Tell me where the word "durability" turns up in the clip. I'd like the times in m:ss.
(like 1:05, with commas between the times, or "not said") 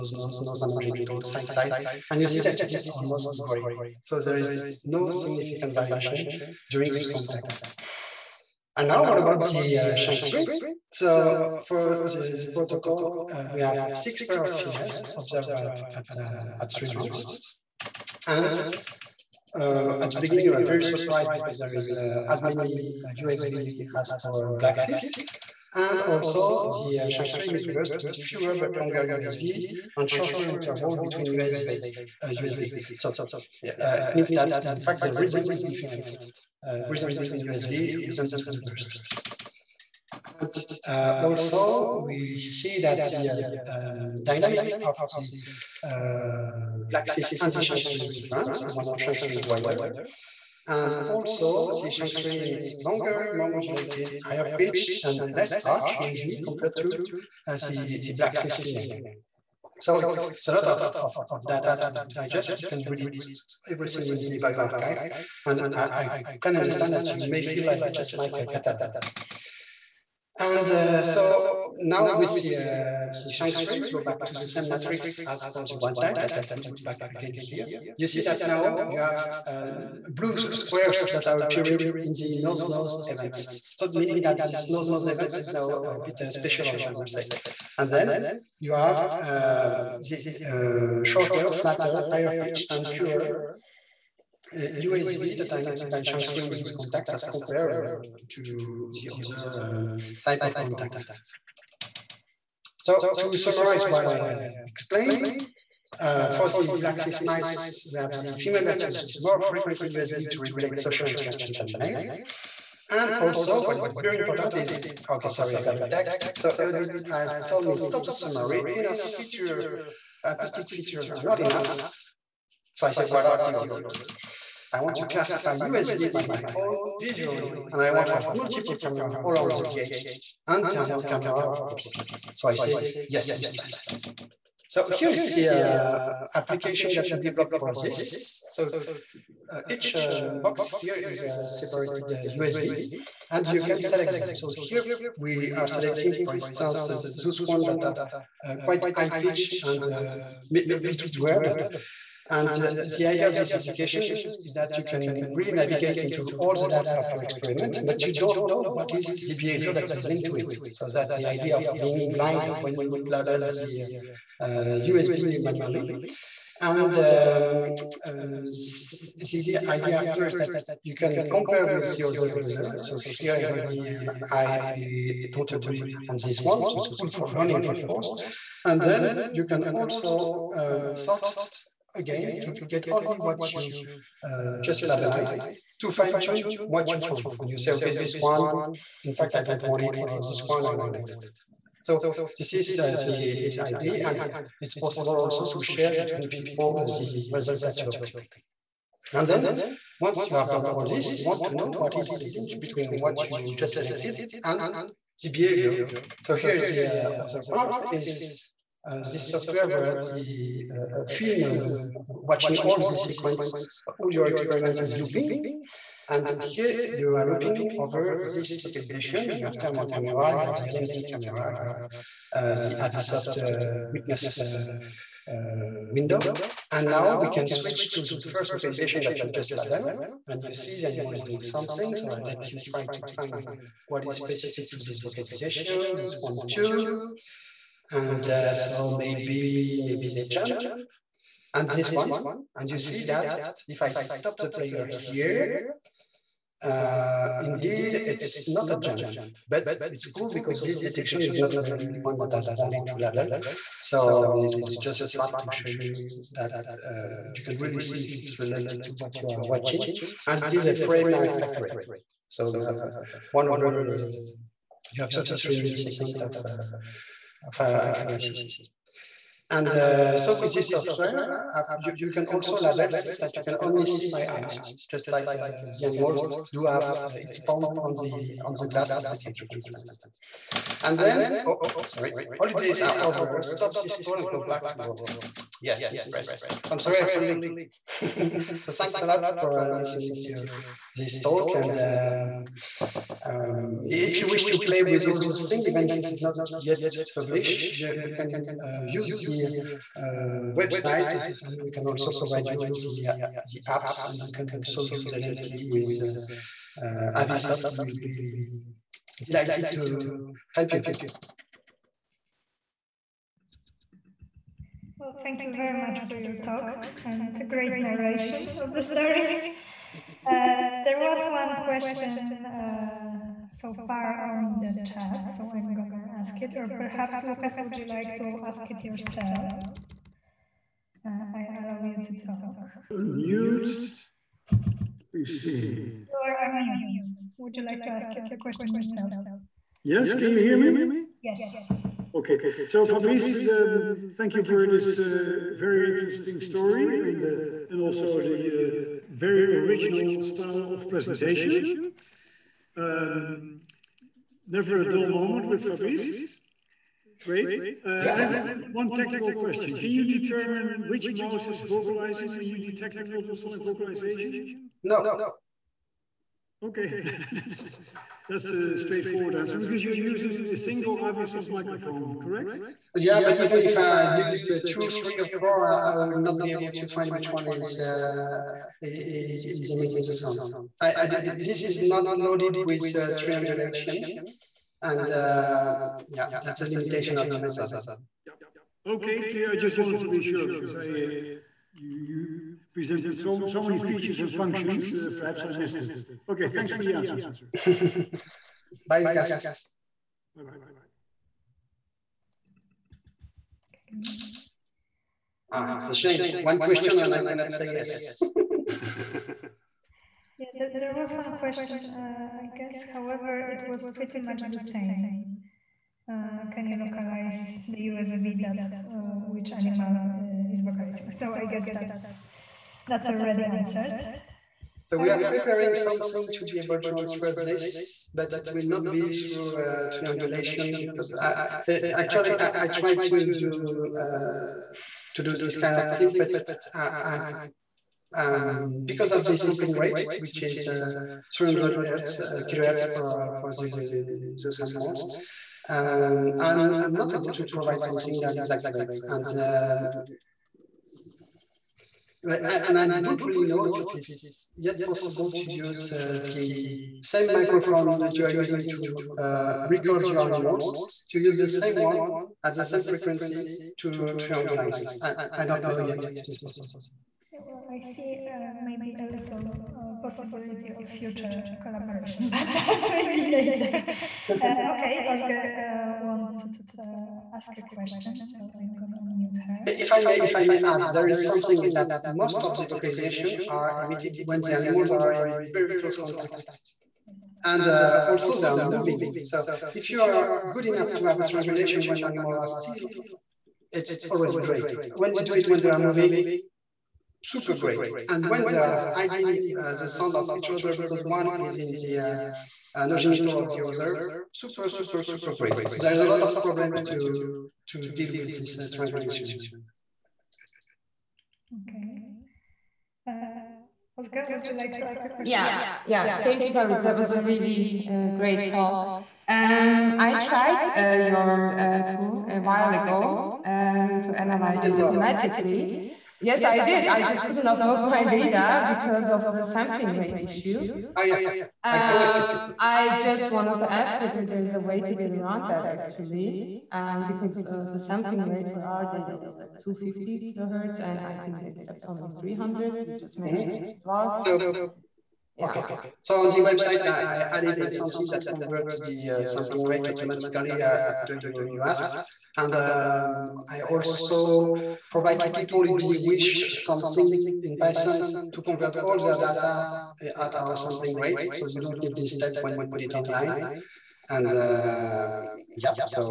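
not said.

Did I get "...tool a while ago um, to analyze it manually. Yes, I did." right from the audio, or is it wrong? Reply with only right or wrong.
wrong.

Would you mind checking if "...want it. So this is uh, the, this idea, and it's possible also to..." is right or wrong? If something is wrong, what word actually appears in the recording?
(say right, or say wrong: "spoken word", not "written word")
right.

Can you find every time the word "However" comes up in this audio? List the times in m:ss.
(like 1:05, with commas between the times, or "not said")
6:52.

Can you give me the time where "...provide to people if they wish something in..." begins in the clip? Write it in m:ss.
9:14.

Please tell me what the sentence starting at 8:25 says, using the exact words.
So there's a lot of problems to, to deal with this uh, triangulation.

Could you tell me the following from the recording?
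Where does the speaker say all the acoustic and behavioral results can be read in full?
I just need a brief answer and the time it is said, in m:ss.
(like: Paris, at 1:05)
bioRxiv, at 1:04.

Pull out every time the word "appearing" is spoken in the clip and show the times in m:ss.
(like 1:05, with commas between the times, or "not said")
1:21.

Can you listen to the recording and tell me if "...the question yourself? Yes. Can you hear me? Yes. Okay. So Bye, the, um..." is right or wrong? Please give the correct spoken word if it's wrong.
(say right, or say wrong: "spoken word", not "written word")
wrong: "Fabrice", not "Bye".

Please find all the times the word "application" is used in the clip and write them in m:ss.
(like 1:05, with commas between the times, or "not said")
2:16, 2:33.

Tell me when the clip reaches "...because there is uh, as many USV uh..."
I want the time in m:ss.
0:21.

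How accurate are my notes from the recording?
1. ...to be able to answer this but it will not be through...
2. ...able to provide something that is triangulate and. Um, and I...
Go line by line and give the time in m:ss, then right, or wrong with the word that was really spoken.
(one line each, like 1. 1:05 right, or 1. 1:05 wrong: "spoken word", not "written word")
1. 7:06 right
2. 7:27 wrong: "accurate", not "triangulate".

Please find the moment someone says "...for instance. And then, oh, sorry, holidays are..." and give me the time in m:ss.
4:39.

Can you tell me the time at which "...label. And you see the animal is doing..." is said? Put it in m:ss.
3:49.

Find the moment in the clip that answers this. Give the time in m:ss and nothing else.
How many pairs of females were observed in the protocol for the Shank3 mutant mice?
0:13.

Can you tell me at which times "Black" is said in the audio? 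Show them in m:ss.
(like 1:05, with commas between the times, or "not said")
0:24, 0:46, 0:58, 1:46.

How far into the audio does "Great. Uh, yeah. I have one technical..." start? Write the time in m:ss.
5:57.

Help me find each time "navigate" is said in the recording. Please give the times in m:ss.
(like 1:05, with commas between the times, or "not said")
2:35.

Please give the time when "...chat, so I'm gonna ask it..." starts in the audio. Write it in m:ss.
5:24.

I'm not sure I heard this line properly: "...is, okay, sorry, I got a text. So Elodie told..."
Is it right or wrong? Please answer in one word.
right.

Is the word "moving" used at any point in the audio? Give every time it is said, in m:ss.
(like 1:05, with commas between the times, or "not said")
8:08, 8:15.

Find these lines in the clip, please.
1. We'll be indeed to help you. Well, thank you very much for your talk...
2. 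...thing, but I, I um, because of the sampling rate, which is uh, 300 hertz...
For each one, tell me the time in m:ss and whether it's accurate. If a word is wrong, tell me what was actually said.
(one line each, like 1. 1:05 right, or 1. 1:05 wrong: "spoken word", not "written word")
1. 5:07 wrong: "delighted", not "indeed"
2. 7:15 right.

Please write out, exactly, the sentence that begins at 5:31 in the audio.
Uh, I allow you to talk.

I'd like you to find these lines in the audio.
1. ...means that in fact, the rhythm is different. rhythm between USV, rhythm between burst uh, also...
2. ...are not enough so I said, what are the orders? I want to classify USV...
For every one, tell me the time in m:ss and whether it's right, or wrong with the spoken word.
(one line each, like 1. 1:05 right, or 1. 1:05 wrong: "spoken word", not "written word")
1. 0:34 right
2. 2:01 right.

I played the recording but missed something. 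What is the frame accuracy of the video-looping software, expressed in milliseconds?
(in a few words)
33 milliseconds.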